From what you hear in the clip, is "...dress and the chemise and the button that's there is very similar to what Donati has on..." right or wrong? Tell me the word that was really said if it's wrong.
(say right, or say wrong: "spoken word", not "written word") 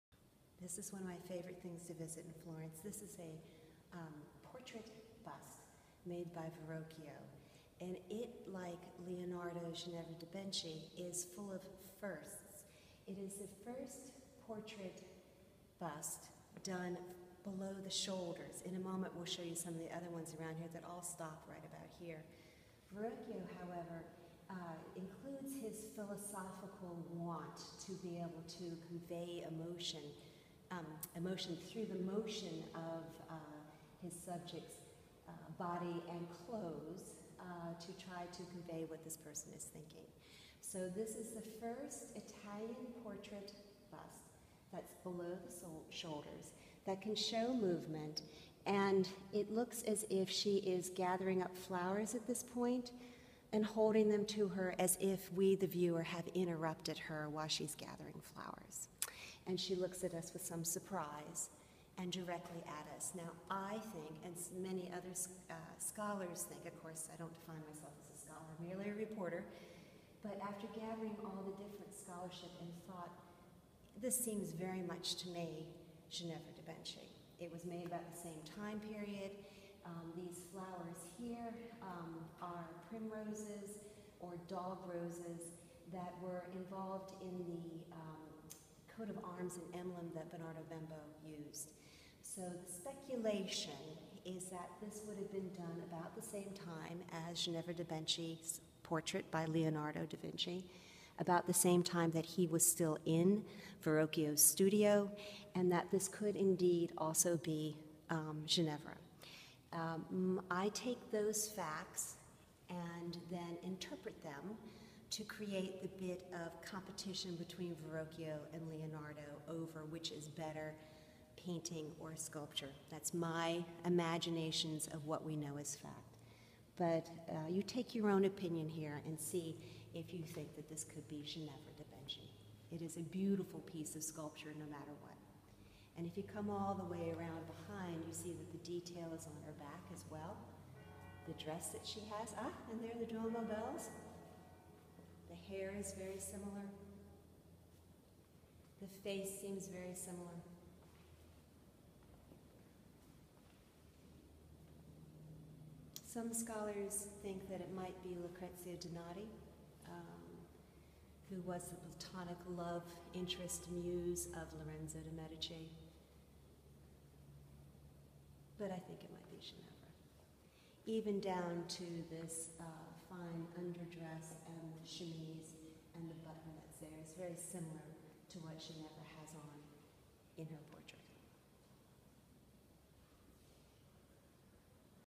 wrong: "Ginevra", not "Donati".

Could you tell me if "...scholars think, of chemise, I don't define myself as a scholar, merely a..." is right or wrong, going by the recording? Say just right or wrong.
wrong.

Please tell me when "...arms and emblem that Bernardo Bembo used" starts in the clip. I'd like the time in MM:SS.
01:29.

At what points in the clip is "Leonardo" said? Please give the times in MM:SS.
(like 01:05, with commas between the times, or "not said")
00:09, 01:39, 01:58.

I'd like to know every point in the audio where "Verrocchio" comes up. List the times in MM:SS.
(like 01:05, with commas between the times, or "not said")
00:06, 00:22, 01:43, 01:57.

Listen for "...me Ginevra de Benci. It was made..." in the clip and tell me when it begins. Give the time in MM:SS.
01:15.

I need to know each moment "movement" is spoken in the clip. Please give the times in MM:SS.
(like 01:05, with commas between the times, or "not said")
00:47.